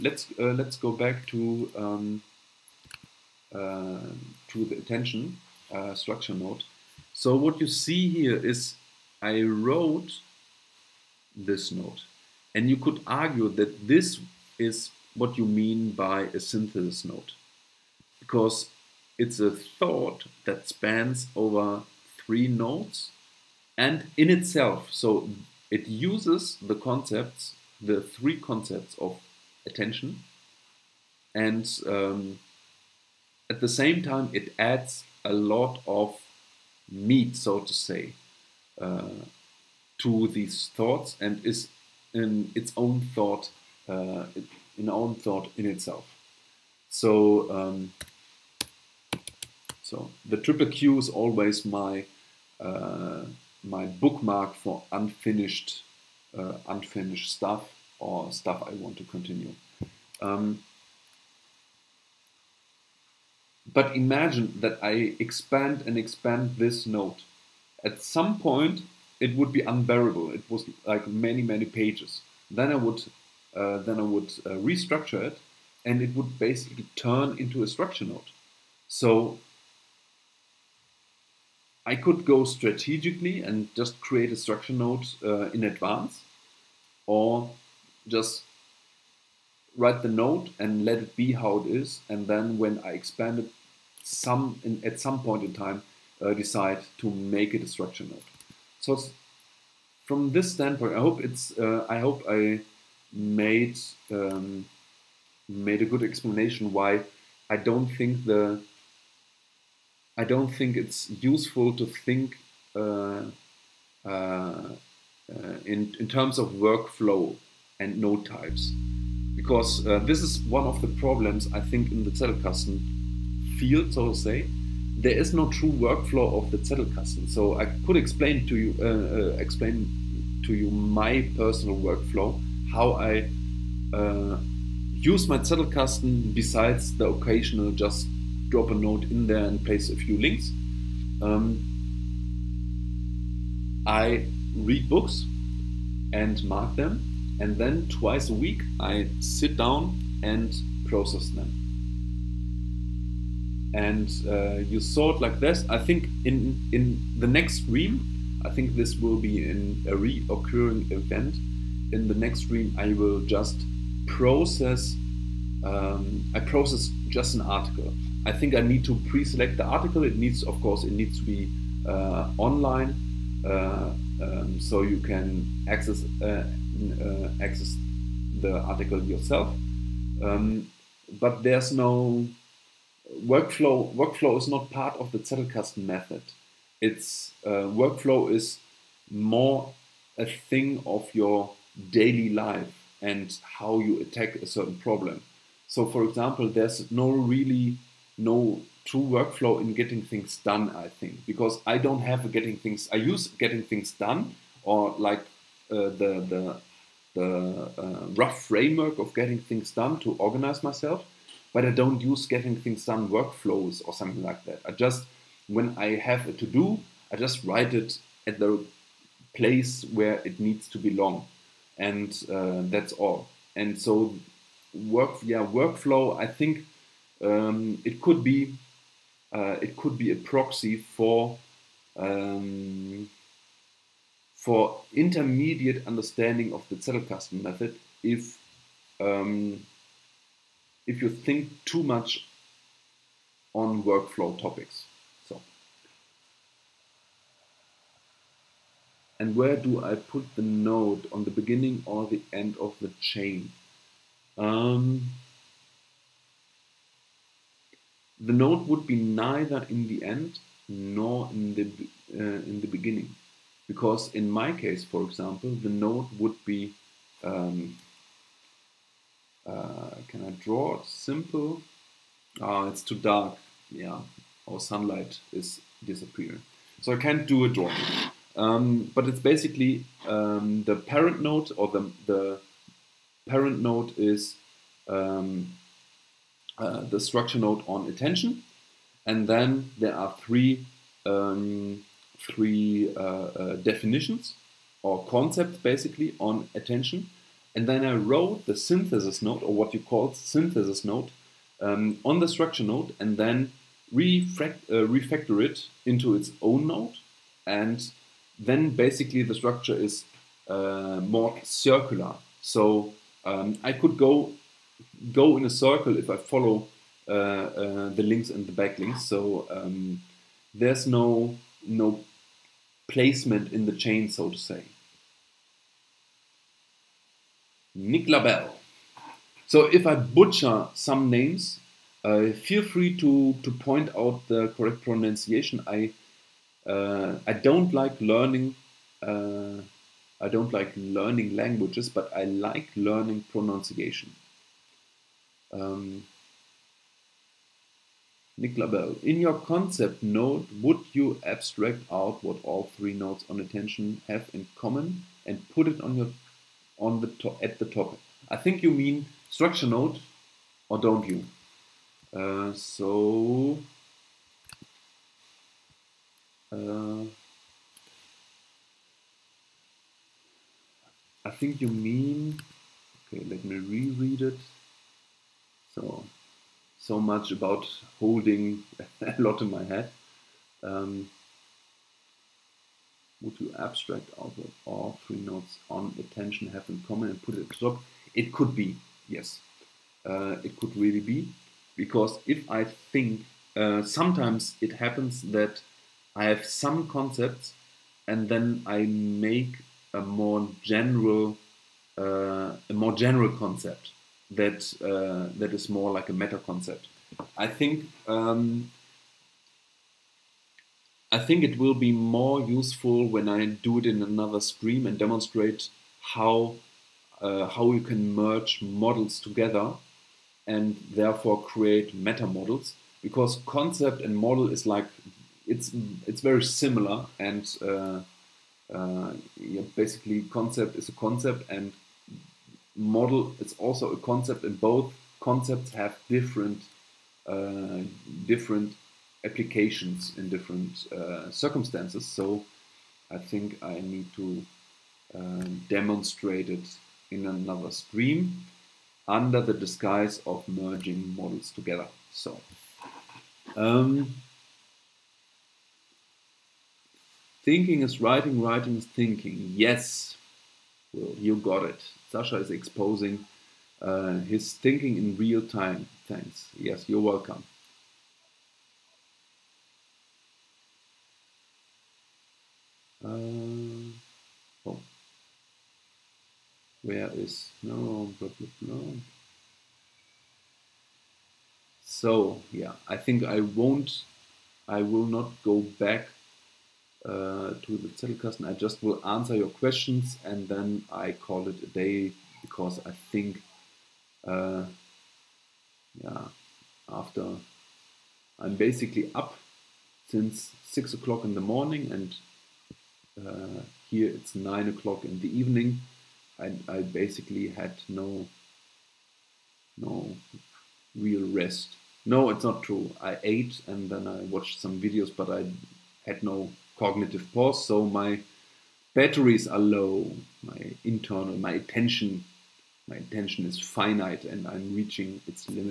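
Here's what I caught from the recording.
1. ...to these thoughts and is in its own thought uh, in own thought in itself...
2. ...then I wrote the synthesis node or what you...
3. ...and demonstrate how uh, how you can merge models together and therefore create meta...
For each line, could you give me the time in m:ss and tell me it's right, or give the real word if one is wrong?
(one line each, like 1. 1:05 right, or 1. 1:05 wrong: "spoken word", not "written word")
1. 0:39 right
2. 4:57 right
3. 6:54 right.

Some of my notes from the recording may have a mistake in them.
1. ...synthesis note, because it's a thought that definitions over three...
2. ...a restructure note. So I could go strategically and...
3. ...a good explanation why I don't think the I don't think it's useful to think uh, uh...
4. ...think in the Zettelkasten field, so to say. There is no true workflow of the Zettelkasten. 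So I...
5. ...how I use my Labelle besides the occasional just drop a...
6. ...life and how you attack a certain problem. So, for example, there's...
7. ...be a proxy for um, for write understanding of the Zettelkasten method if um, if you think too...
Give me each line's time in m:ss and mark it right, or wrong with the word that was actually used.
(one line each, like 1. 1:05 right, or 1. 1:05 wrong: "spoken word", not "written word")
1. 0:16 wrong: "spans", not "definitions"
2. 1:17 wrong: "structure", not "restructure"
3. 1:45 right
4. 2:01 right
5. 2:12 wrong: "Zettelkasten", not "Labelle"
6. 3:12 right
7. 3:49 wrong: "intermediate", not "write".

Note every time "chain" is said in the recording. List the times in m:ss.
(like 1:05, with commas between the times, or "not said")
4:12, 5:23.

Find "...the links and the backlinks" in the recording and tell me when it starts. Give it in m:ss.
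5:17.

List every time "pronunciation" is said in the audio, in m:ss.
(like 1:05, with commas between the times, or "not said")
5:34, 5:43.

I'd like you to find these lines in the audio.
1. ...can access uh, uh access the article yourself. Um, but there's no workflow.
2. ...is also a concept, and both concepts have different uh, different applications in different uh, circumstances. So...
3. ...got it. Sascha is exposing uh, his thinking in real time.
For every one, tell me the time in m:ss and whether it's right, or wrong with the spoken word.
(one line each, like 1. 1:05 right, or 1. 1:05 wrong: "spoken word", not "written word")
1. 2:54 right
2. 7:13 right
3. 7:41 right.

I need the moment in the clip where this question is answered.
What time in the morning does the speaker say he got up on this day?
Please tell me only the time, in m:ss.
8:20.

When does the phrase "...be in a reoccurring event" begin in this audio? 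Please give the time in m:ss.
2:39.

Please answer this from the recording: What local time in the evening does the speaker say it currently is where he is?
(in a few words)
9 o'clock.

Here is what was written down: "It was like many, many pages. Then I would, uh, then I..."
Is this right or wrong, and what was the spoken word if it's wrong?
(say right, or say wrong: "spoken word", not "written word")
right.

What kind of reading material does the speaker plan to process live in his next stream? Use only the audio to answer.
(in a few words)
an article.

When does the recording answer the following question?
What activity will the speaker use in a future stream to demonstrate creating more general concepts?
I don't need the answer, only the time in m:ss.
7:30.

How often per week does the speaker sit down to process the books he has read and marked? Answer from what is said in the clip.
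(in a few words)
twice a week.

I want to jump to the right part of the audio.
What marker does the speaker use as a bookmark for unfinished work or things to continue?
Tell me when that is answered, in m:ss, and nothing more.
0:50.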